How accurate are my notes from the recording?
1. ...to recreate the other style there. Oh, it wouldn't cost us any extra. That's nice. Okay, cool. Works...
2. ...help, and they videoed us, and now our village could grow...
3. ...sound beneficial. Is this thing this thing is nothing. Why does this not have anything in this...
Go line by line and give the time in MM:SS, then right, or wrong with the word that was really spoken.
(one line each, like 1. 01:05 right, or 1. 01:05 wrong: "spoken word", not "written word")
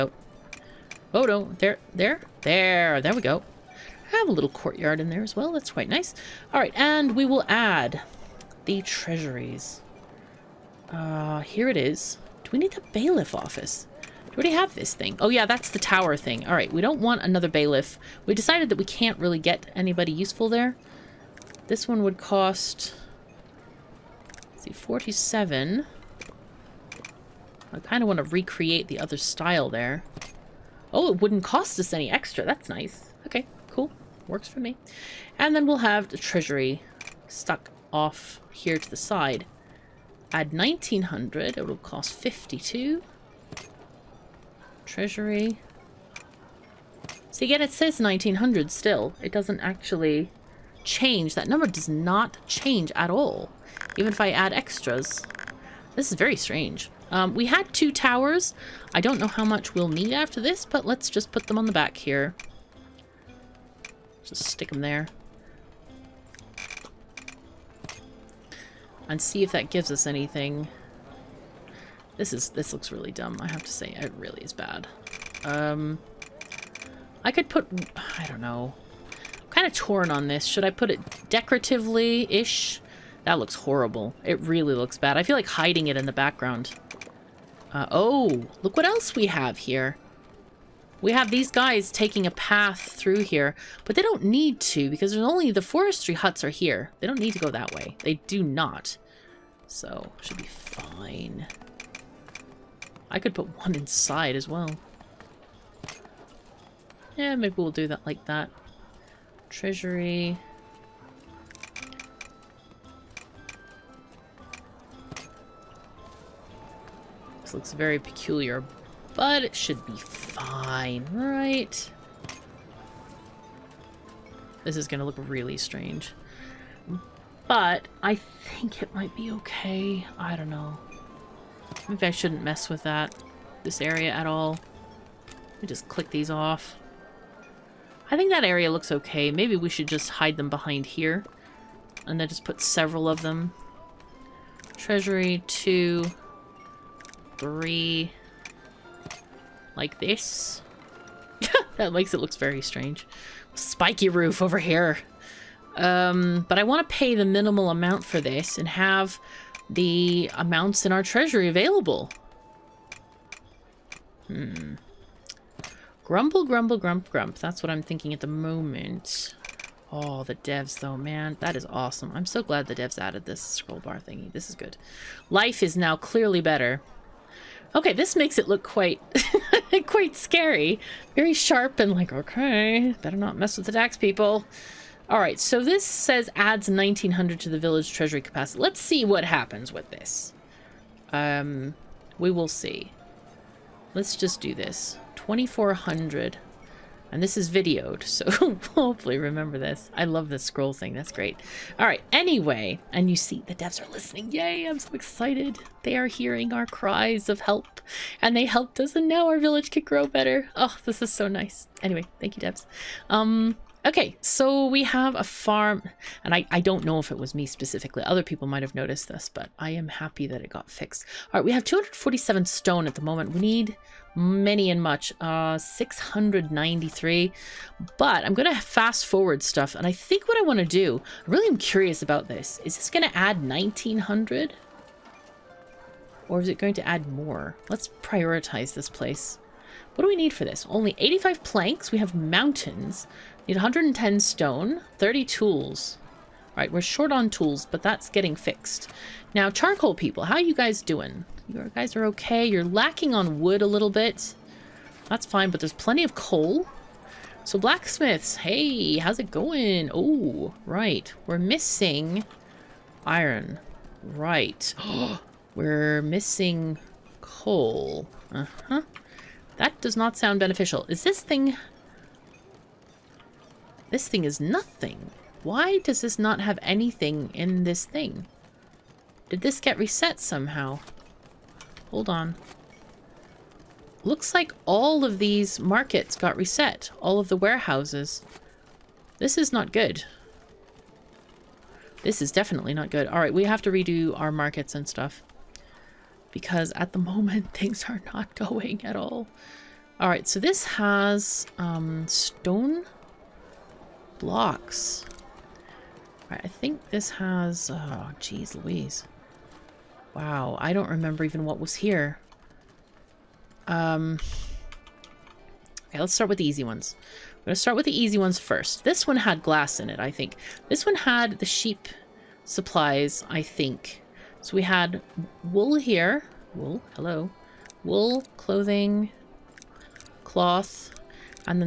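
1. 00:28 right
2. 03:27 wrong: "helped", not "videoed"
3. 04:30 right.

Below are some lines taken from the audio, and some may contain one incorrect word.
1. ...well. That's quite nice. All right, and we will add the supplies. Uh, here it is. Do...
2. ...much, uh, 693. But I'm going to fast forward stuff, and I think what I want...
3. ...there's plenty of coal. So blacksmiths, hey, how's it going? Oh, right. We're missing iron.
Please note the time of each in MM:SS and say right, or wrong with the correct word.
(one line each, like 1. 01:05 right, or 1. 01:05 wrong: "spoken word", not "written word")
1. 00:05 wrong: "treasuries", not "supplies"
2. 03:44 right
3. 04:15 right.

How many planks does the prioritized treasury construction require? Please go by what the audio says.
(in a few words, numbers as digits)
85.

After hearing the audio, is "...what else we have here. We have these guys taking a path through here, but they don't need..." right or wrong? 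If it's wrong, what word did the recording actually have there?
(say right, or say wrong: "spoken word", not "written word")
right.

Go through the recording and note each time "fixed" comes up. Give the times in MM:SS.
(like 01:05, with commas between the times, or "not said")
03:40, 04:08.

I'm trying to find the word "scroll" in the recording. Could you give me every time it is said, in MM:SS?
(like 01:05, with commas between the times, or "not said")
02:53, 03:20.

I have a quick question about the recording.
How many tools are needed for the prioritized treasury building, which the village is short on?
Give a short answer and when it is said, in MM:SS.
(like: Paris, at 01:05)
30, at 04:04.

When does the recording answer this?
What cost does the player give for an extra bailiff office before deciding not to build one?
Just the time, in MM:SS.
00:24.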